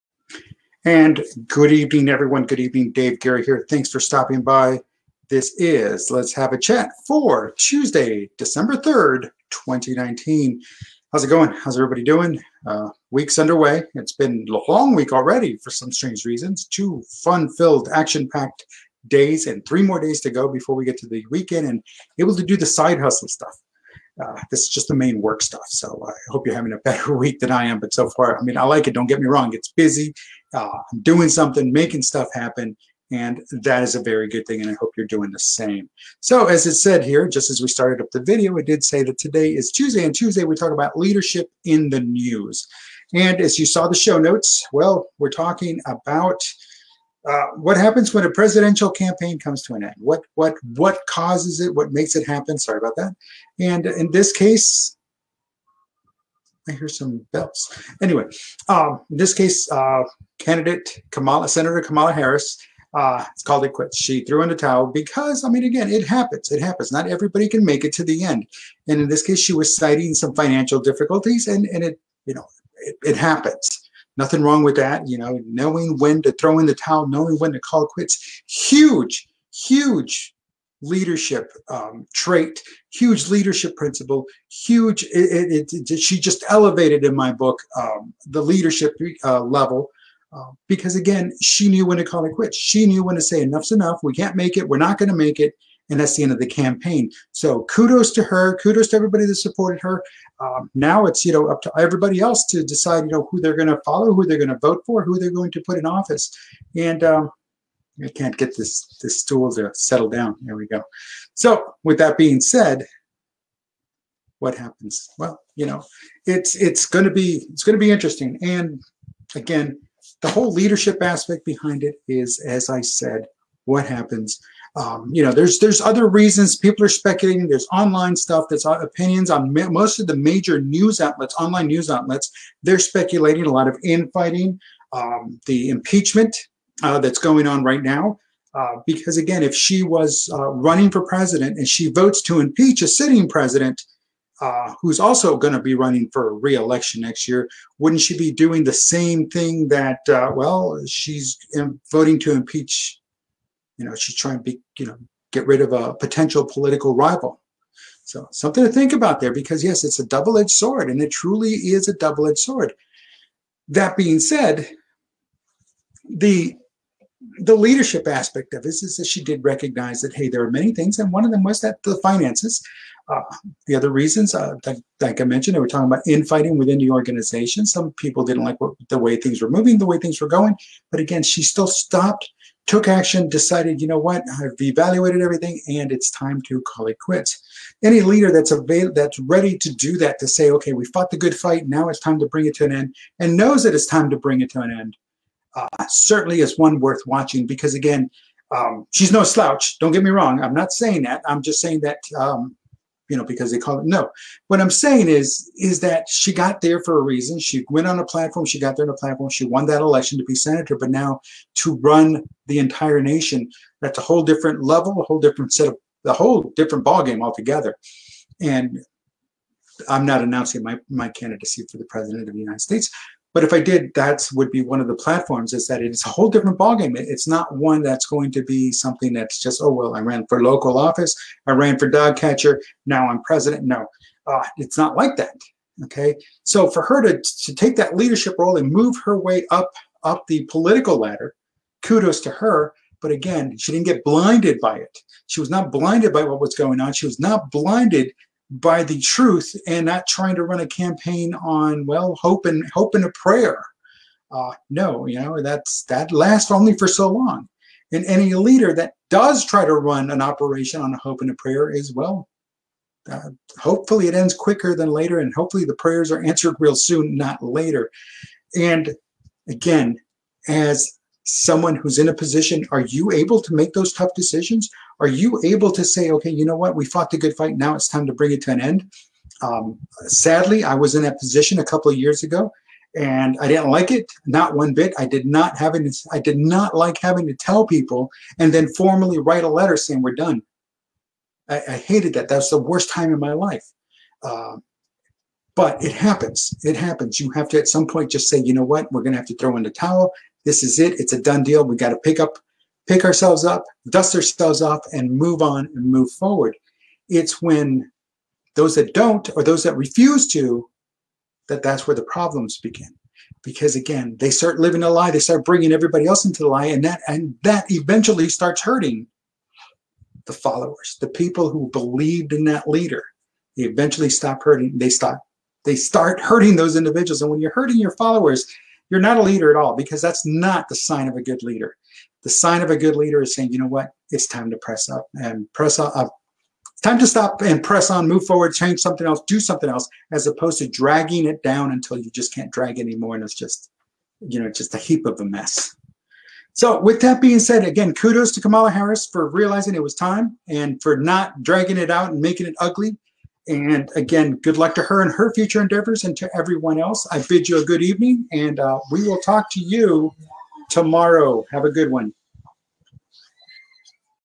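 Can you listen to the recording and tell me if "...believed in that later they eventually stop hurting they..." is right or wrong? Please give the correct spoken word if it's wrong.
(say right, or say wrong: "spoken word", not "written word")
wrong: "leader", not "later".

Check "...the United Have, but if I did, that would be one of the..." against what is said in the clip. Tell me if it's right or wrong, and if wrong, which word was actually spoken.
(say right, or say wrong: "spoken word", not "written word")
wrong: "States", not "Have".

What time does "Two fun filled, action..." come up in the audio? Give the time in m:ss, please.
0:16.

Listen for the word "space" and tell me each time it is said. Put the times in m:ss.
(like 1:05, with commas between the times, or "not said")
not said.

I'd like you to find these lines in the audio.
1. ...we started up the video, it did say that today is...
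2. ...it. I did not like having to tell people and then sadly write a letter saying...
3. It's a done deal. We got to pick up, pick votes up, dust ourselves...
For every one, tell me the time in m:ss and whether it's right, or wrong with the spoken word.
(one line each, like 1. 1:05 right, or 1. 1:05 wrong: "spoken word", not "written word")
1. 0:37 right
2. 4:45 wrong: "formally", not "sadly"
3. 5:00 wrong: "ourselves", not "votes".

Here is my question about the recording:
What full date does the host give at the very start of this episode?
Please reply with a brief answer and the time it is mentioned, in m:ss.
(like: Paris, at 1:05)
Tuesday, December 3rd, 2019, at 0:07.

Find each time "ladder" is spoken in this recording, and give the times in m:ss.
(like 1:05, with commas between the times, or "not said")
4:00.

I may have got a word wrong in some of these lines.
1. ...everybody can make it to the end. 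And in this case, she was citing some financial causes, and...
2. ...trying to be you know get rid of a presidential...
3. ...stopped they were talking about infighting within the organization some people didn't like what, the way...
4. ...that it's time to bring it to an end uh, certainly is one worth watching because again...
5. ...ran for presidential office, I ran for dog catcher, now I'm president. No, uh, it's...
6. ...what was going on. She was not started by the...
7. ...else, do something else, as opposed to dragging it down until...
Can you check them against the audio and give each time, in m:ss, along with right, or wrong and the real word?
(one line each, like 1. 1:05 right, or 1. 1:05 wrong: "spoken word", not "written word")
1. 1:07 wrong: "difficulties", not "causes"
2. 2:34 wrong: "potential", not "presidential"
3. 2:55 wrong: "mentioned", not "stopped"
4. 3:13 right
5. 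3:50 wrong: "local", not "presidential"
6. 4:06 wrong: "blinded", not "started"
7. 5:39 right.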